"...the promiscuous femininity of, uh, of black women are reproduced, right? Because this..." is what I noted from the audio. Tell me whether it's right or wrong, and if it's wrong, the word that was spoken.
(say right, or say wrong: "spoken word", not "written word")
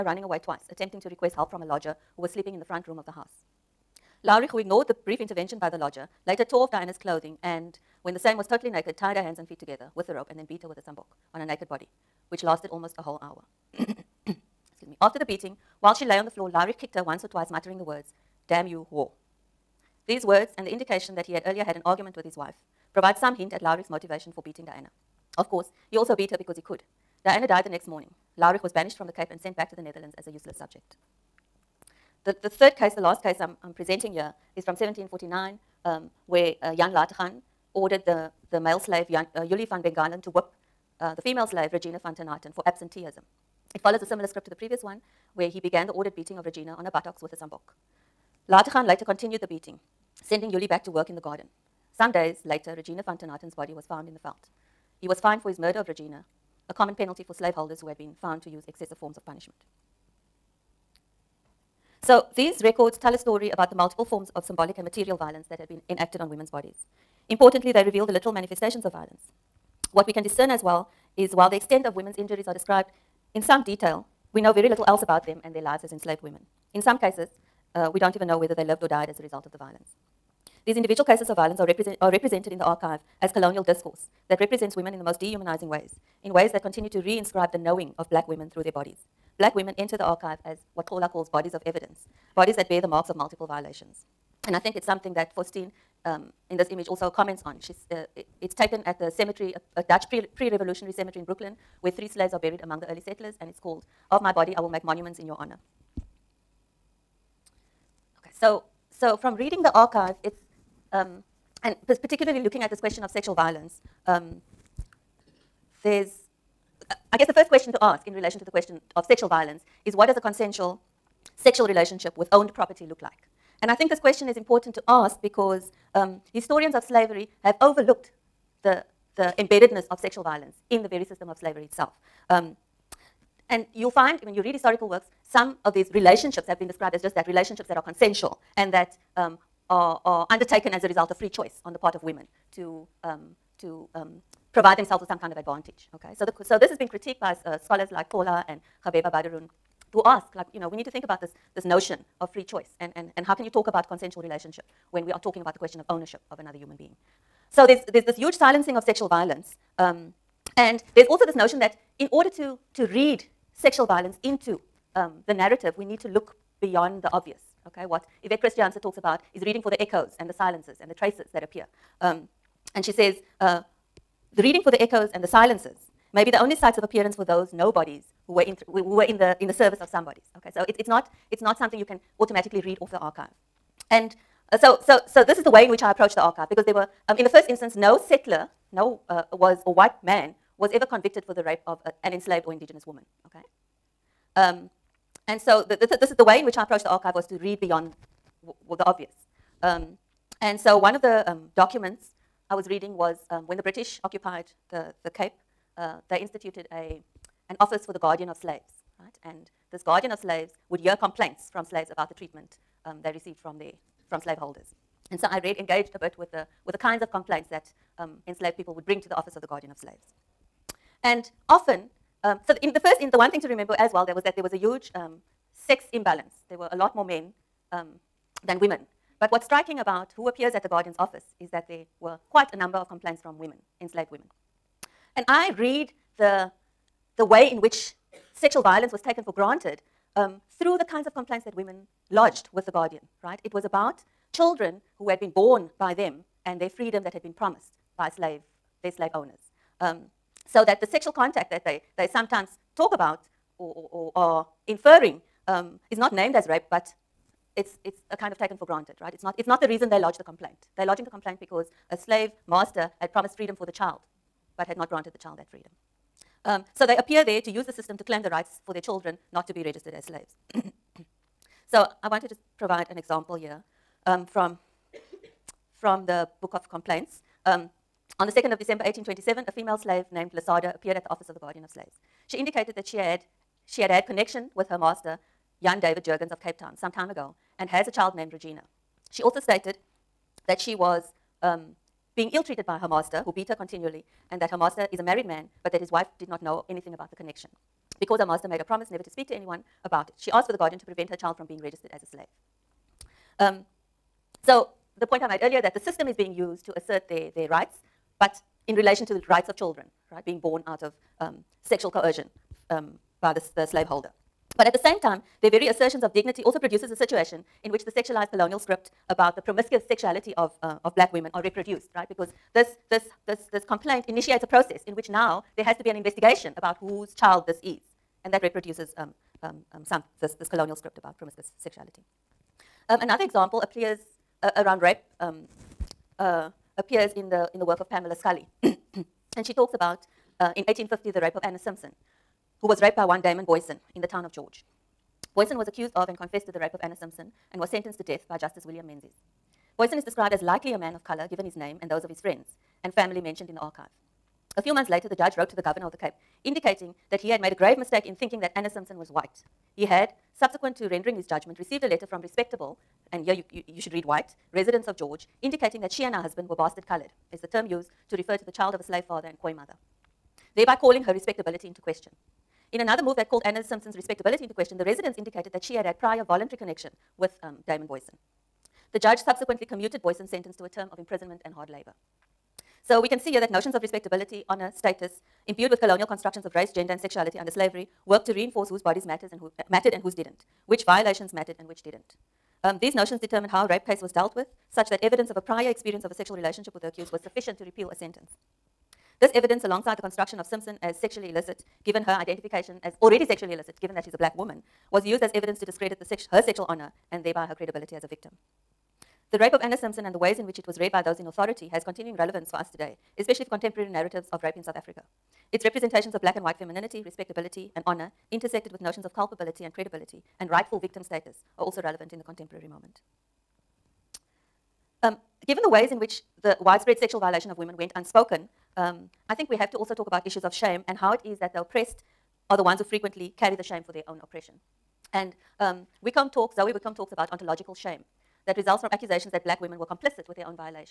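wrong: "sexuality", not "femininity".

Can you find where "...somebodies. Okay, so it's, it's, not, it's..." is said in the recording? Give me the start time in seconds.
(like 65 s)
179 s.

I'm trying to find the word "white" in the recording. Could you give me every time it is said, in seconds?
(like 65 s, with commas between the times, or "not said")
189 s, 359 s, 364 s, 416 s.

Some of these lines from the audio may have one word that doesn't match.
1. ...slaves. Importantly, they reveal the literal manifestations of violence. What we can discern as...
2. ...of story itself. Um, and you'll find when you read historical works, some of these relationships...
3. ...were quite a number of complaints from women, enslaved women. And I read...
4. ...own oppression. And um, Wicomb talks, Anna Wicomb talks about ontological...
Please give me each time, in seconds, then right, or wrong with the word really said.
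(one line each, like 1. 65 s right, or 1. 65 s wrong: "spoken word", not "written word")
1. 66 s wrong: "bodies", not "slaves"
2. 131 s wrong: "slavery", not "story"
3. 232 s right
4. 434 s wrong: "Zoe", not "Anna".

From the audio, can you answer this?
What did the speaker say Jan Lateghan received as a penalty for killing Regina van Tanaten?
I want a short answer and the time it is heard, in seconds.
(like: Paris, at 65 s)
fined, at 55 s.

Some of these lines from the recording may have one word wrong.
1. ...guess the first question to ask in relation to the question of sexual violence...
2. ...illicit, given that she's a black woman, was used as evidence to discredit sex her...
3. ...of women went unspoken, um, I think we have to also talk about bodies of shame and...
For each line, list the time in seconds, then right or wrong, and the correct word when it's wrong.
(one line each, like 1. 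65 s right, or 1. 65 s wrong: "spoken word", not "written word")
1. 117 s right
2. 403 s right
3. 427 s wrong: "issues", not "bodies".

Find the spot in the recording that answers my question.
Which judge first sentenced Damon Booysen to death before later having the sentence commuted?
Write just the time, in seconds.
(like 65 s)
348 s.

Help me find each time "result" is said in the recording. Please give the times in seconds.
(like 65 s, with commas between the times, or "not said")
79 s, 140 s, 438 s.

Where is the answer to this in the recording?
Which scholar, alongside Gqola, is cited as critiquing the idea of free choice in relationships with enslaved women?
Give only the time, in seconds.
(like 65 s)
148 s.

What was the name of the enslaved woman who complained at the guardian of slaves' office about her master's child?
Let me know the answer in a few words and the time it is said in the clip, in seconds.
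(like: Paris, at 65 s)
Lasada, at 280 s.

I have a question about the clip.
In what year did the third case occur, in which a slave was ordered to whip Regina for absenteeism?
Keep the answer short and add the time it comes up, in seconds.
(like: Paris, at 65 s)
1749, at 34 s.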